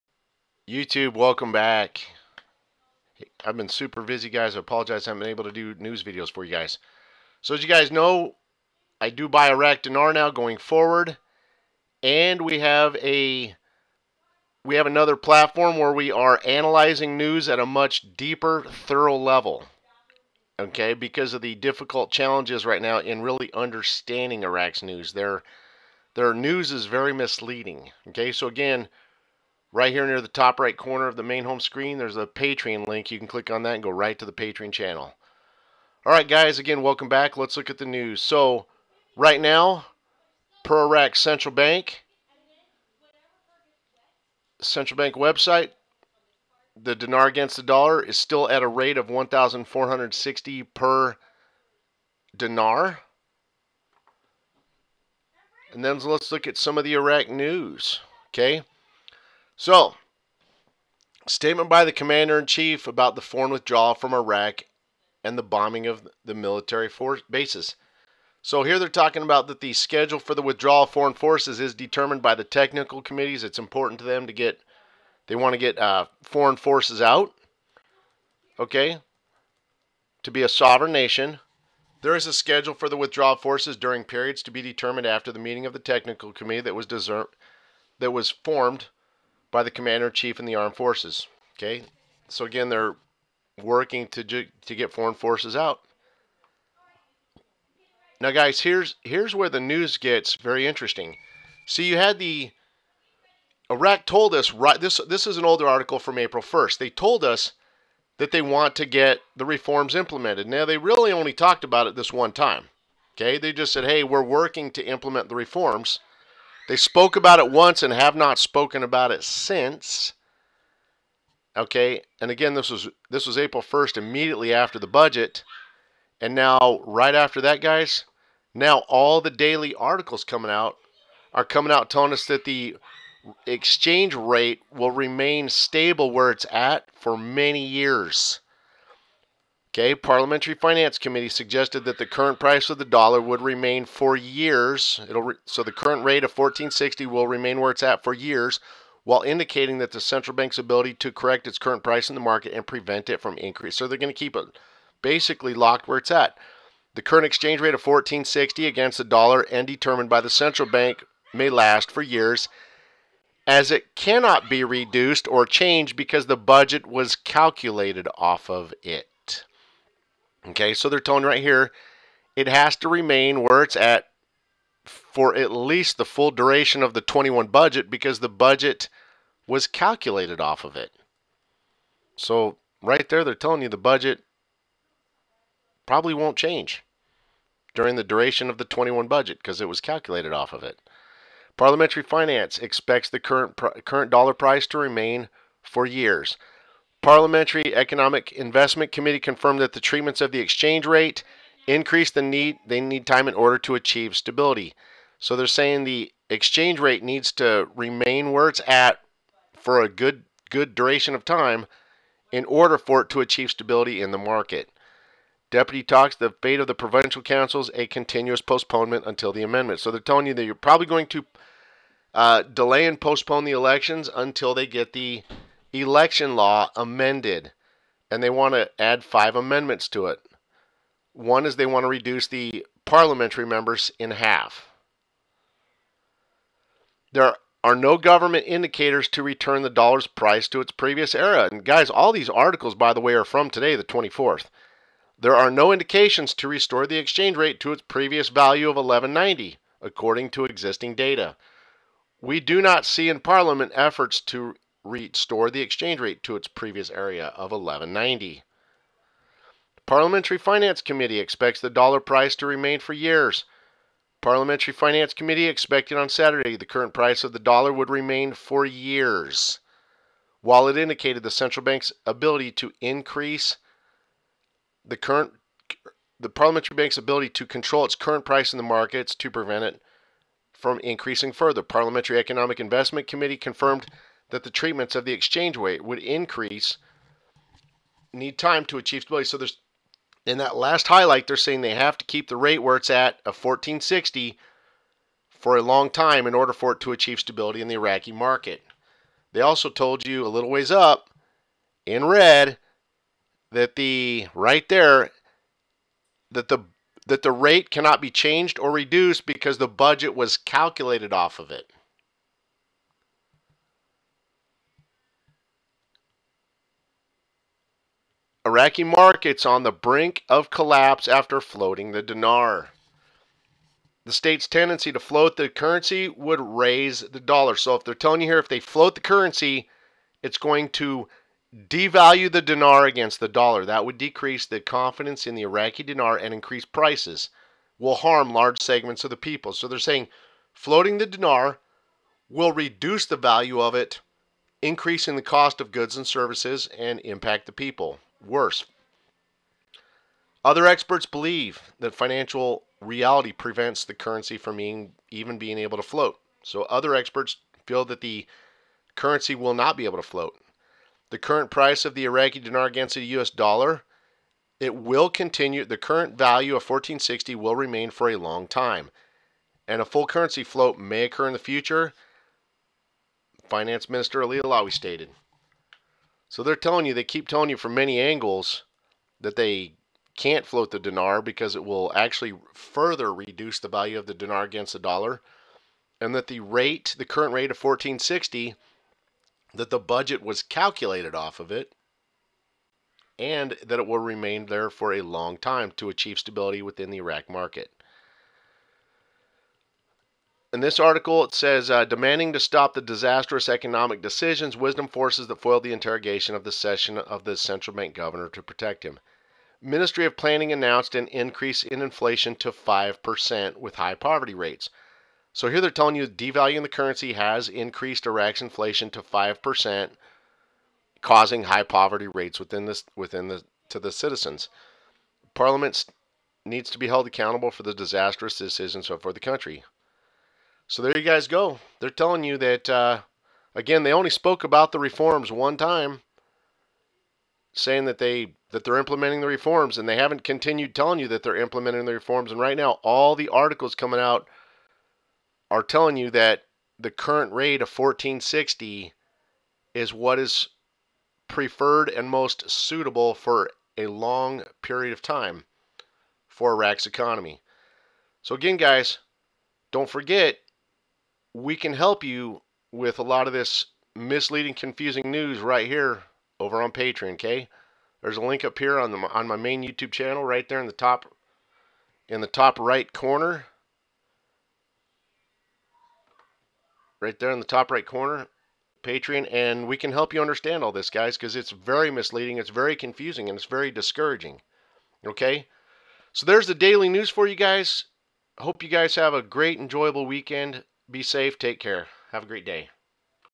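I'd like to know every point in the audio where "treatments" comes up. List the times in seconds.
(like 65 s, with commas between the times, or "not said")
199 s, 284 s.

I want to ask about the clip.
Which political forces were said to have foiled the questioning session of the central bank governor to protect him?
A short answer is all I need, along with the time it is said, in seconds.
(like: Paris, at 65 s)
wisdom forces, at 404 s.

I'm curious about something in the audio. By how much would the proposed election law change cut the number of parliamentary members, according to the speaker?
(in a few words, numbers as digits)
in half.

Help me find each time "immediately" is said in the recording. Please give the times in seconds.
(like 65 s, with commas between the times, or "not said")
123 s.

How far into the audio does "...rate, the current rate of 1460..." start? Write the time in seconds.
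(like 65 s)
386 s.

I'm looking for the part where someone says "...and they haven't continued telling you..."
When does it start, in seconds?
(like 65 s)
439 s.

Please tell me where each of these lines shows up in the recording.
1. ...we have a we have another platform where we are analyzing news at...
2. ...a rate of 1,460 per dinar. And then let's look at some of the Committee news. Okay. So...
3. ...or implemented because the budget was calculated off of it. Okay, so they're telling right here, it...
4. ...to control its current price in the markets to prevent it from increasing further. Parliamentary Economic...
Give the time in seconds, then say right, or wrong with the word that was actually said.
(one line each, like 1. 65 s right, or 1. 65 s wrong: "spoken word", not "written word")
1. 12 s right
2. 48 s wrong: "Iraq", not "Committee"
3. 165 s wrong: "changed", not "implemented"
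4. 277 s right.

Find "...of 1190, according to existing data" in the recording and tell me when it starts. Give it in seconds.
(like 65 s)
248 s.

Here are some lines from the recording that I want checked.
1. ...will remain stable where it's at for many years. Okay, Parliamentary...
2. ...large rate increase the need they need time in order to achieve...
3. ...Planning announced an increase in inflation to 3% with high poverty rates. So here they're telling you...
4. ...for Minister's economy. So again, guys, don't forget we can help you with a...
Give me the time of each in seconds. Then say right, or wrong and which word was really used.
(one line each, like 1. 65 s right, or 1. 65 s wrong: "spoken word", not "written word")
1. 134 s right
2. 200 s wrong: "exchange", not "large"
3. 410 s wrong: "5", not "3"
4. 456 s wrong: "Iraq", not "Minister".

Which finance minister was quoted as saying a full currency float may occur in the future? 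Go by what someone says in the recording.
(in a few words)
Ali Alawi.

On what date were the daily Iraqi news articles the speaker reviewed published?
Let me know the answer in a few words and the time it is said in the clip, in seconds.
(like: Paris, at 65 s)
the 24th, at 243 s.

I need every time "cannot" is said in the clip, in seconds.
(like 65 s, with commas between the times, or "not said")
163 s, 307 s.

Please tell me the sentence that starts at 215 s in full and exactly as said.
Deputy talks the fate of the provincial councils a continuous postponement until the amendment.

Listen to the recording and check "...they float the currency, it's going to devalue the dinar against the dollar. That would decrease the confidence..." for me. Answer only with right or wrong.
right.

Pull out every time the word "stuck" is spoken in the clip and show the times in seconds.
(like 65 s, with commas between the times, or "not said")
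not said.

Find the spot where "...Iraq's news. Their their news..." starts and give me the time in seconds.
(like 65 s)
24 s.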